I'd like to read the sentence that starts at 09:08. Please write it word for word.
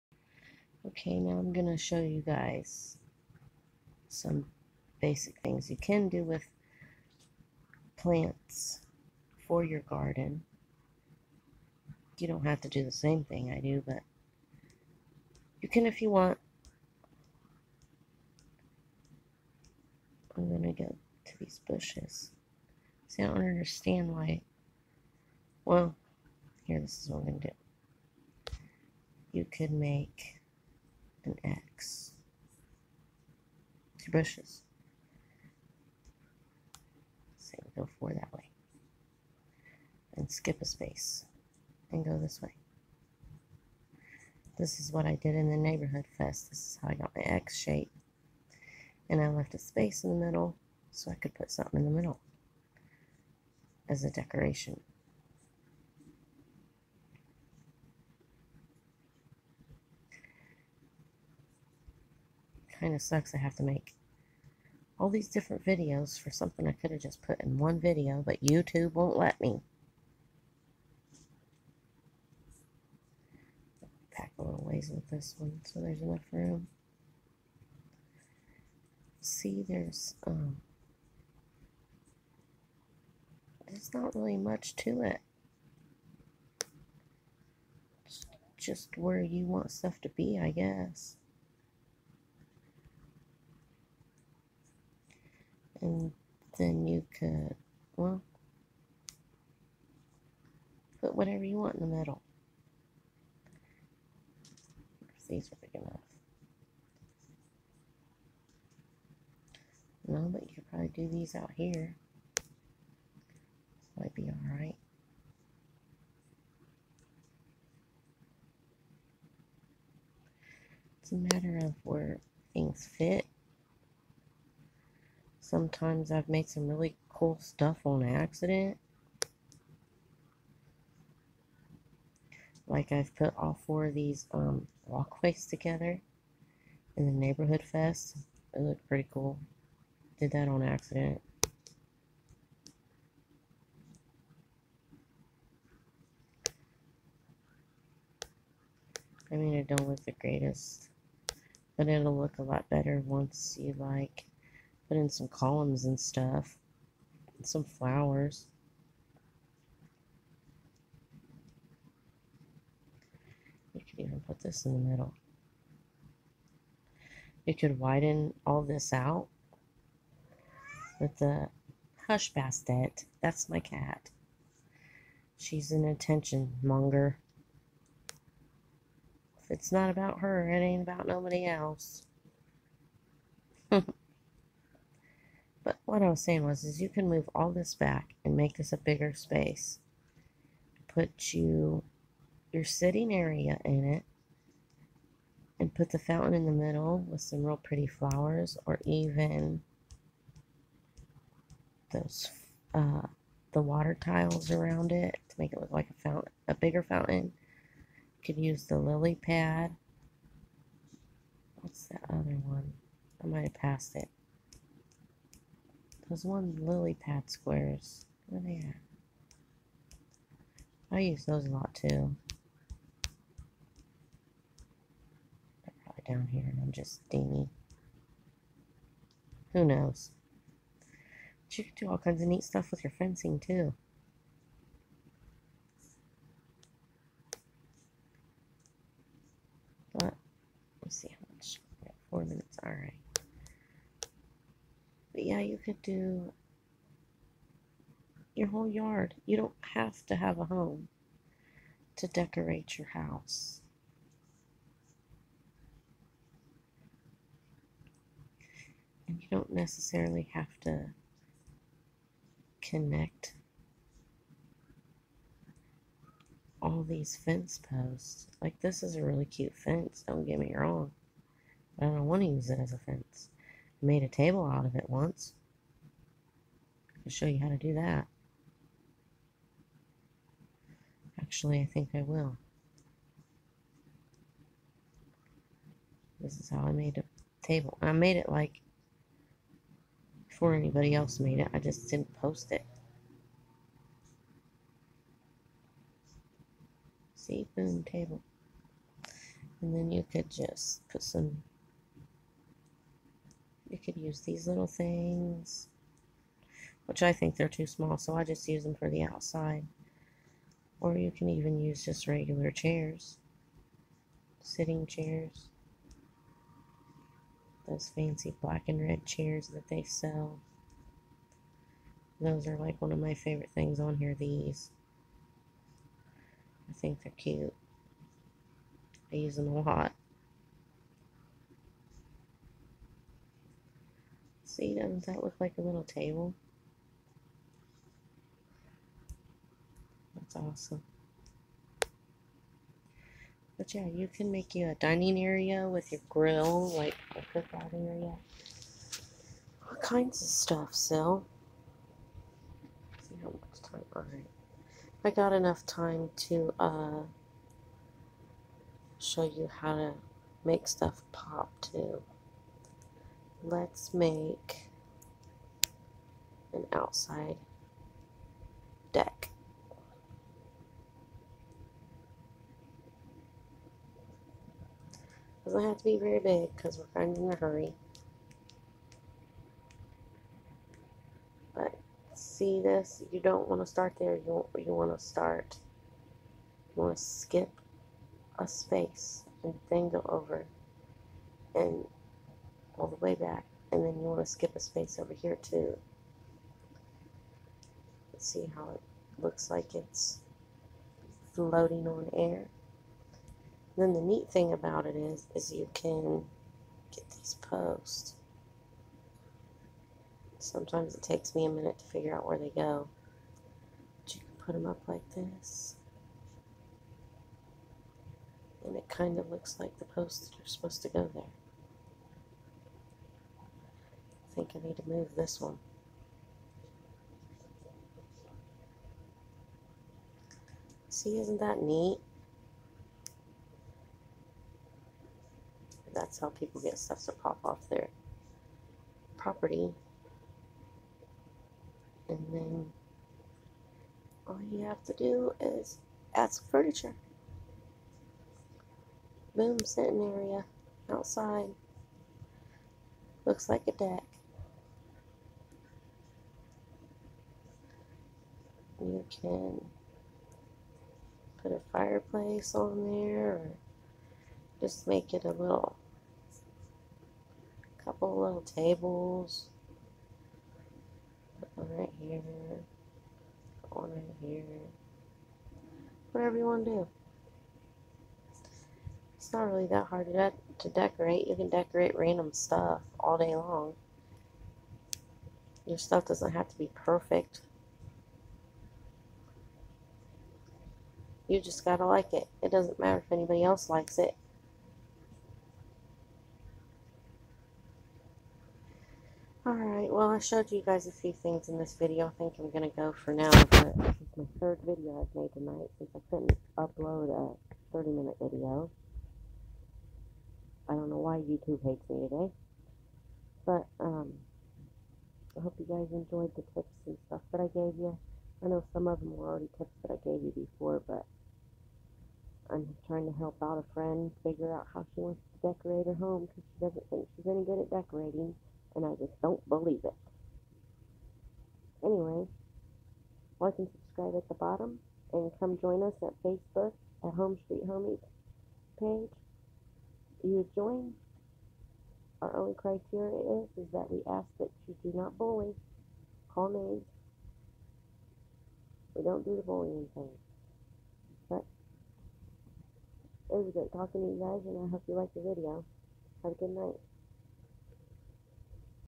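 We don't do the bullying thing.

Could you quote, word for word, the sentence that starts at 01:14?
Pack a little ways with this one so there's enough room.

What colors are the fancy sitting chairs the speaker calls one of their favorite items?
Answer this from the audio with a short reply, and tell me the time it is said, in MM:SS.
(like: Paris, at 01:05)
black and red, at 05:18.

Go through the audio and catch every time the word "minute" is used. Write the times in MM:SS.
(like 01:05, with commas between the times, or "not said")
04:02, 06:51, 08:27.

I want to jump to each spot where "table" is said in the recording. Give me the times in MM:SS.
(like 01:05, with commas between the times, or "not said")
04:34, 04:47, 04:57, 05:35, 07:48.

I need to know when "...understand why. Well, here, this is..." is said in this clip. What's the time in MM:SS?
00:23.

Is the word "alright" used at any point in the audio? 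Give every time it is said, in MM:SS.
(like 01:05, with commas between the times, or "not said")
01:54, 05:53, 08:19.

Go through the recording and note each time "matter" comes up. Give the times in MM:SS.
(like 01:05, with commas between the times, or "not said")
02:01, 08:12.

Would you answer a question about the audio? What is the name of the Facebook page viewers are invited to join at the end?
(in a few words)
Home Street Homies.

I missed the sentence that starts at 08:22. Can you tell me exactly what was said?
I think I'm going to go for now.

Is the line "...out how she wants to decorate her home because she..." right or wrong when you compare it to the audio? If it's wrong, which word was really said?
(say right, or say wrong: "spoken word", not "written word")
right.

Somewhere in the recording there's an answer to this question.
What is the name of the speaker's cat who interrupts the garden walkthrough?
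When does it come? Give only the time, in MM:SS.
02:52.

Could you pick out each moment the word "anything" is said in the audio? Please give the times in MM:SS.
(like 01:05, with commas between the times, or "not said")
not said.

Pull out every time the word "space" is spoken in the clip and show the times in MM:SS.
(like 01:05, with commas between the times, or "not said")
00:40, 00:49, 03:09, 06:28, 06:34.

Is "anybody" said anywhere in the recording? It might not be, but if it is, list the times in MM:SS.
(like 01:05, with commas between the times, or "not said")
04:50, 08:13.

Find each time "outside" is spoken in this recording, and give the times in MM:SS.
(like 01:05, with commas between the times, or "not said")
05:09, 06:06, 07:30.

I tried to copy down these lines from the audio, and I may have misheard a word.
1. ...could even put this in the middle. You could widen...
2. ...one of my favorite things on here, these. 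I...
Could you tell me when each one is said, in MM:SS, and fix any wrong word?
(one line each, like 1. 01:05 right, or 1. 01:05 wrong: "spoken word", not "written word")
1. 02:43 right
2. 05:22 right.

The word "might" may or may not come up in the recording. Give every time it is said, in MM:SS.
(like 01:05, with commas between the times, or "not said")
01:54, 03:33.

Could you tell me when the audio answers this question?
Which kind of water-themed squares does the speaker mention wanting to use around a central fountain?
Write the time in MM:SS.
03:36.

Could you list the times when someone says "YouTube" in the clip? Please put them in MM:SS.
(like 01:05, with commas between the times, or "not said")
01:08, 08:31.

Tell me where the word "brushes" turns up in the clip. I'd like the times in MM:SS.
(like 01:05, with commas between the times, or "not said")
00:34.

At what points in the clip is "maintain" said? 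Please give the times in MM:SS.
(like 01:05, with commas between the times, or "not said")
not said.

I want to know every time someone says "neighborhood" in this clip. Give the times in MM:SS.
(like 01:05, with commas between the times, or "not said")
00:45, 02:17.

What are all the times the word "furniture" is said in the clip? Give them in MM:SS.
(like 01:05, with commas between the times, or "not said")
07:26.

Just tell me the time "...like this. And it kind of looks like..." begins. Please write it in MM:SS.
06:54.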